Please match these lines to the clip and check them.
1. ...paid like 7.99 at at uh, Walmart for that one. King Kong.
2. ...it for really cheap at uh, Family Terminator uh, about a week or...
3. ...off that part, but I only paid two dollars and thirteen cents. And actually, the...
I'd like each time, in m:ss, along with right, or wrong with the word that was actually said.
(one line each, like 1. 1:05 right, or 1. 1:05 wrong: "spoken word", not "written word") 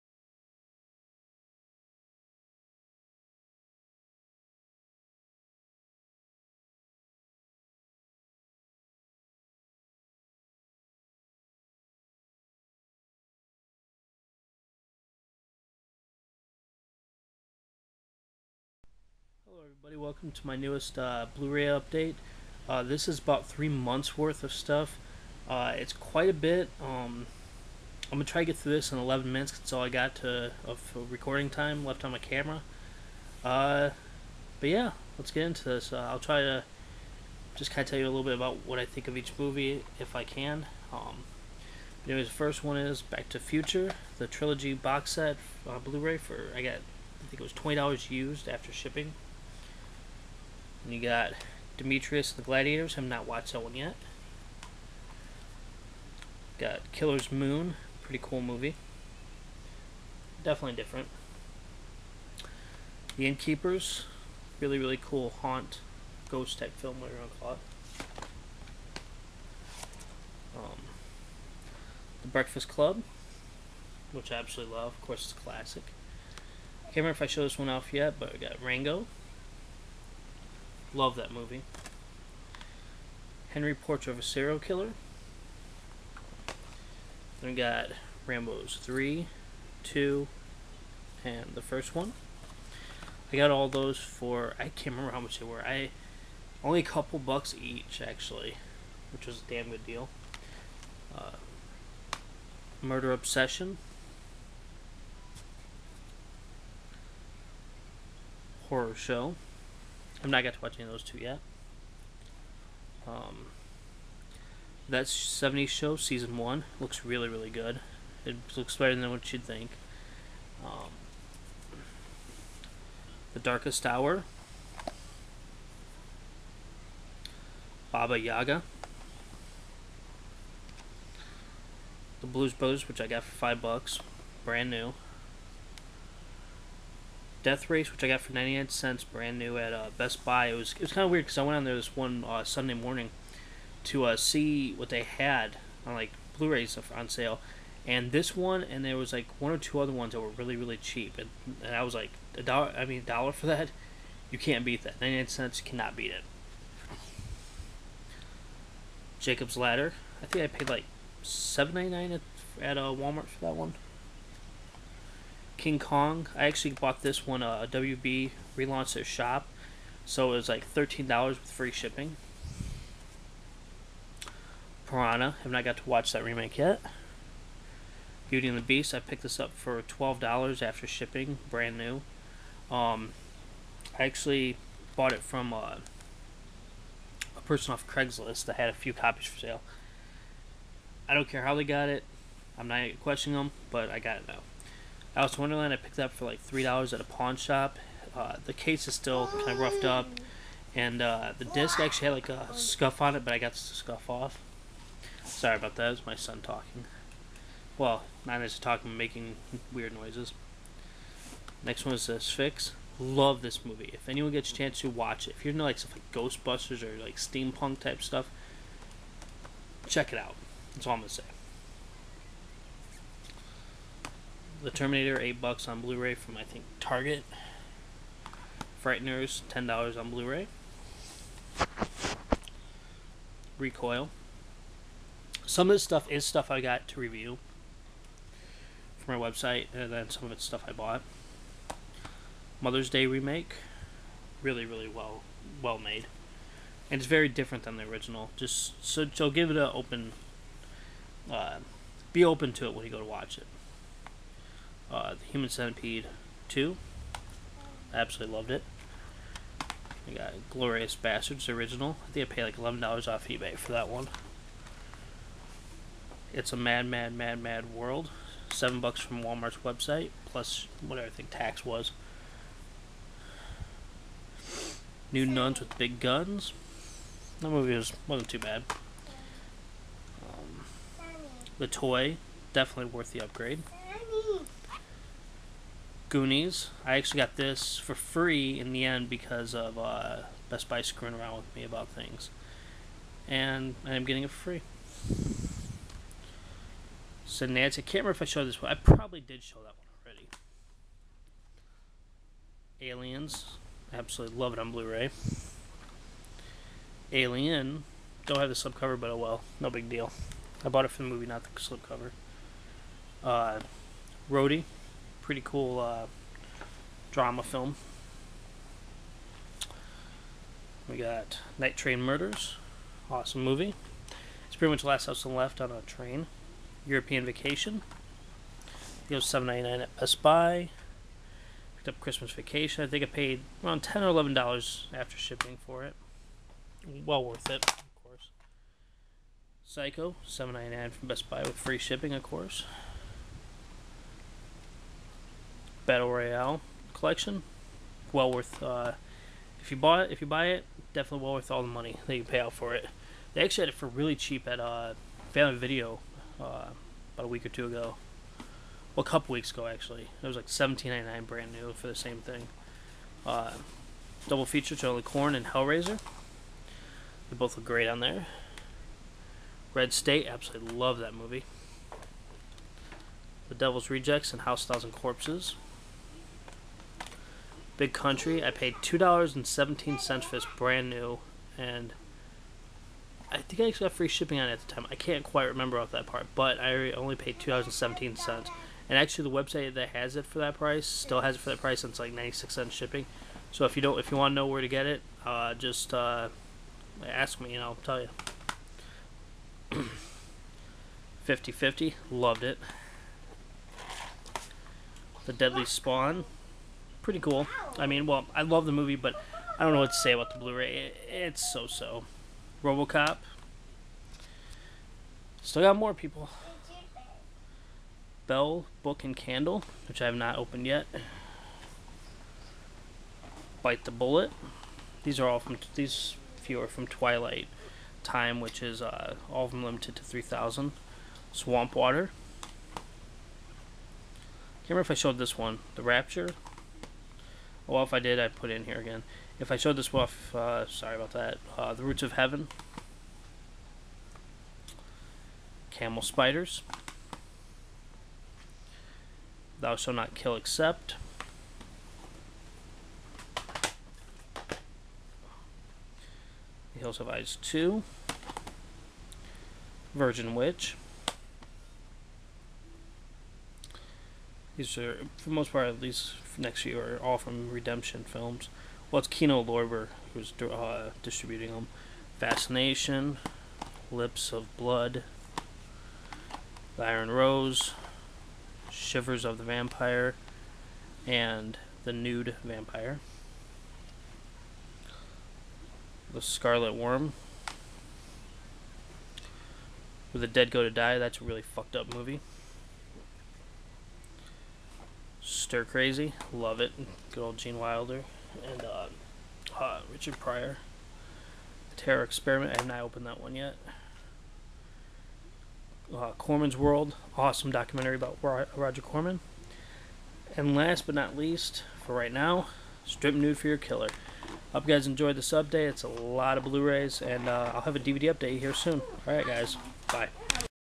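1. 2:40 right
2. 5:53 wrong: "Video", not "Terminator"
3. 6:25 wrong: "seventeen", not "thirteen".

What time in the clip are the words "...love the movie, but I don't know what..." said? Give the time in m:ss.
6:48.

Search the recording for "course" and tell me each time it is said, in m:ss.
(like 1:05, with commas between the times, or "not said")
1:15, 5:38, 5:42.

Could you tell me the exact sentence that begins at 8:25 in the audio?
Uh, Corman's World, awesome documentary about Roger Corman.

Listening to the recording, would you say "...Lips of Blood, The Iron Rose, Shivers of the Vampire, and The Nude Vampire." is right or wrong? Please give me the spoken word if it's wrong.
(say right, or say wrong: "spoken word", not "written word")
right.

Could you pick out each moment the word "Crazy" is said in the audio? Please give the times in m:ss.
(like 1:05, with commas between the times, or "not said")
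8:15.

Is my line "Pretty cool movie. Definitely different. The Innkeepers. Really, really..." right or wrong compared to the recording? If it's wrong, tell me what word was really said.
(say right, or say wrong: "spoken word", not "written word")
right.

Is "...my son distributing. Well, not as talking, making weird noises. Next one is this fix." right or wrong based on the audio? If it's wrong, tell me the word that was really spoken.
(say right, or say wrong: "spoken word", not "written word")
wrong: "talking", not "distributing".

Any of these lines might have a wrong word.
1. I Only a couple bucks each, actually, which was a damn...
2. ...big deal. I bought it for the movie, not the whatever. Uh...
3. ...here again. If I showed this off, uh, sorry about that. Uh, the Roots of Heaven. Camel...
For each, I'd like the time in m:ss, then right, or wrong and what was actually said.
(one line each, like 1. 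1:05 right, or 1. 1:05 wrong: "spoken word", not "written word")
1. 1:35 right
2. 5:09 wrong: "slipcover", not "whatever"
3. 7:18 right.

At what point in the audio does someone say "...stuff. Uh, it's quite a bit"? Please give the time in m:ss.
0:24.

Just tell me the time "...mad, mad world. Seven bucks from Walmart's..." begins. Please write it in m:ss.
4:27.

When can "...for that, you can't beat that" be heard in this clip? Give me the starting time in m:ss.
2:33.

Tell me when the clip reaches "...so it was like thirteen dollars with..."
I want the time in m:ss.
2:50.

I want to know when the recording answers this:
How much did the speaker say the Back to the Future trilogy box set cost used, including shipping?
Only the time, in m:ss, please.
0:47.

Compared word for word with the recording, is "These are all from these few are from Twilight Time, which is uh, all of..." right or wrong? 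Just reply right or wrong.
right.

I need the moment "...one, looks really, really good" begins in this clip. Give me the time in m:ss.
1:56.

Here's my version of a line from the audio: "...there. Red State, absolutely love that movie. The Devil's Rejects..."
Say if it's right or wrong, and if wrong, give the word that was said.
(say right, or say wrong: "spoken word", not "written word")
right.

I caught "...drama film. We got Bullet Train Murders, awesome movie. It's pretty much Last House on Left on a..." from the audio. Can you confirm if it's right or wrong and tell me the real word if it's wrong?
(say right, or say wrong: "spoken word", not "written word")
wrong: "Night", not "Bullet".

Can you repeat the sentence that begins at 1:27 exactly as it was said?
Then we got Rambo's 3, 2, and the first one.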